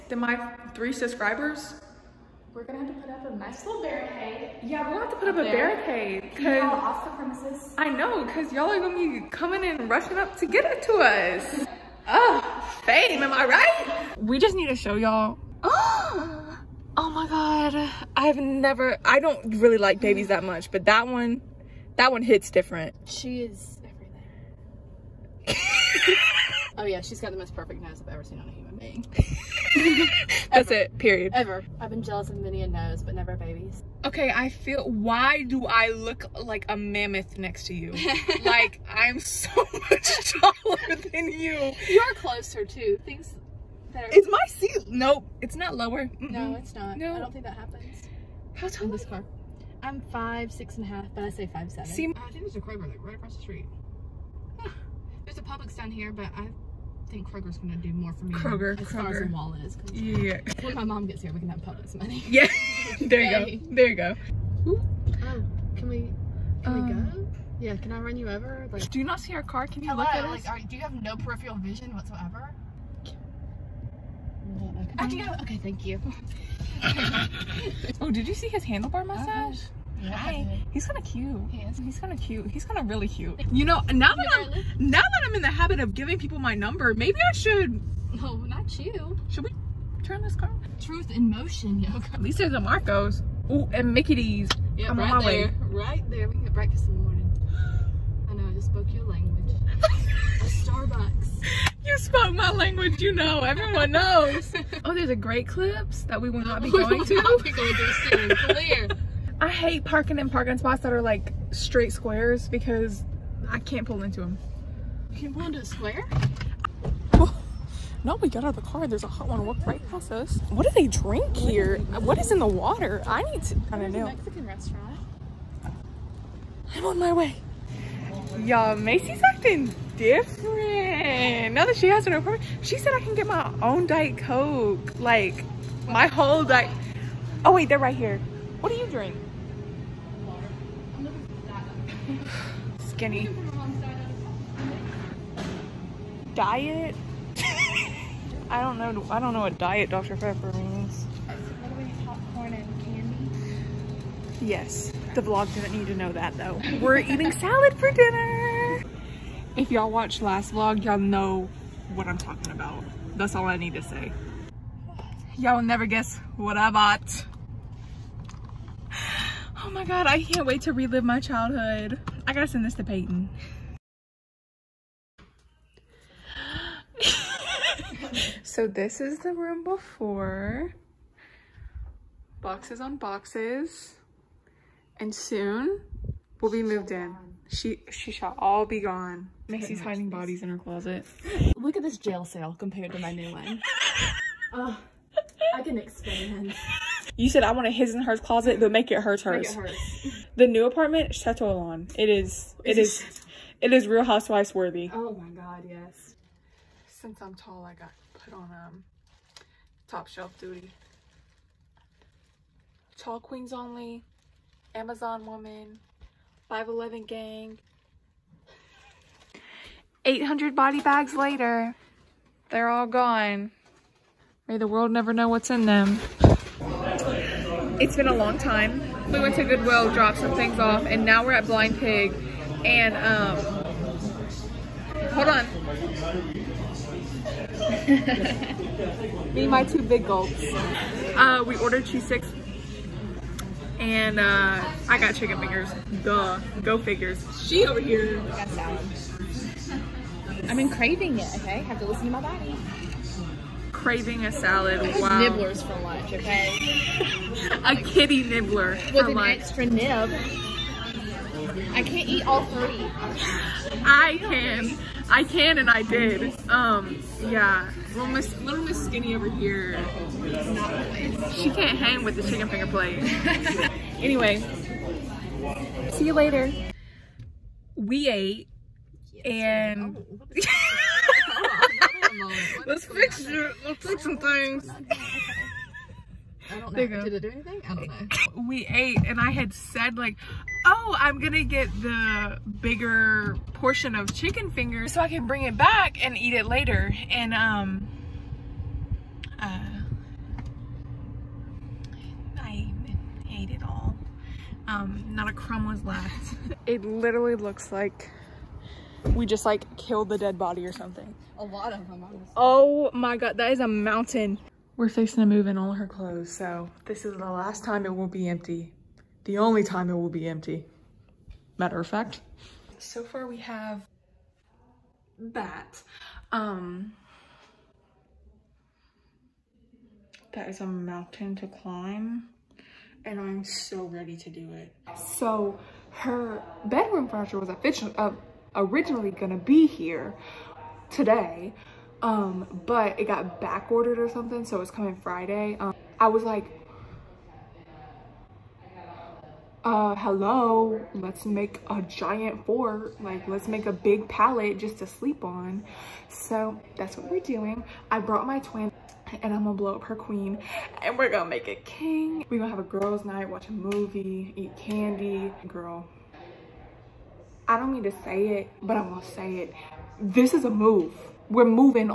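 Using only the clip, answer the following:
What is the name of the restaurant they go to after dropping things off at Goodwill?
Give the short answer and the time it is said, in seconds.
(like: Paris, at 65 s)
Blind Pig, at 231 s.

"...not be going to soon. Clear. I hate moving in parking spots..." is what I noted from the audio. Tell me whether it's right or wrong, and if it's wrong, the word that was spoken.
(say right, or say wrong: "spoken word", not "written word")
wrong: "parking", not "moving".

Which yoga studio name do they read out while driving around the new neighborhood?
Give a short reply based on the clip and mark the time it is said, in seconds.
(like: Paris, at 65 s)
Truth in motion yoga, at 90 s.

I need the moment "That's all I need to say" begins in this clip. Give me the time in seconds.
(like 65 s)
163 s.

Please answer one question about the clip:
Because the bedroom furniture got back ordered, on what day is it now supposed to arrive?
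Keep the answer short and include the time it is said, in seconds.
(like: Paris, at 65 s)
Friday, at 345 s.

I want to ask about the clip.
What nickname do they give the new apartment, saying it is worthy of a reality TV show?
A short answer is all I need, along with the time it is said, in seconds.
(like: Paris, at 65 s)
Chateau Lawn, at 201 s.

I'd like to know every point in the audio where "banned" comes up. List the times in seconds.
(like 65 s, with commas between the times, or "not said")
not said.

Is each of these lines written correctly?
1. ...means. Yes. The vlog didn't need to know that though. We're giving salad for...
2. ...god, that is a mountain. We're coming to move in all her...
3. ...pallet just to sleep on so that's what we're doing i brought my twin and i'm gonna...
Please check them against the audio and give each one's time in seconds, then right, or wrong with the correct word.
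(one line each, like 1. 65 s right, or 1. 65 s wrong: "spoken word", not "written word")
1. 150 s wrong: "eating", not "giving"
2. 313 s wrong: "fixing", not "coming"
3. 354 s right.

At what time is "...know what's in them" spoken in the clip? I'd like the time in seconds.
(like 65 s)
225 s.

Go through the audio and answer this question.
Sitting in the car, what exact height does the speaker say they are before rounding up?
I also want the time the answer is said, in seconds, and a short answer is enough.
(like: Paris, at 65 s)
5'6.5", at 50 s.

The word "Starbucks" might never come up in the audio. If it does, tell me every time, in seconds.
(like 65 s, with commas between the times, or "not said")
100 s.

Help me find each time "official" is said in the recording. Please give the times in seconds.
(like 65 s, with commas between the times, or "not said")
337 s.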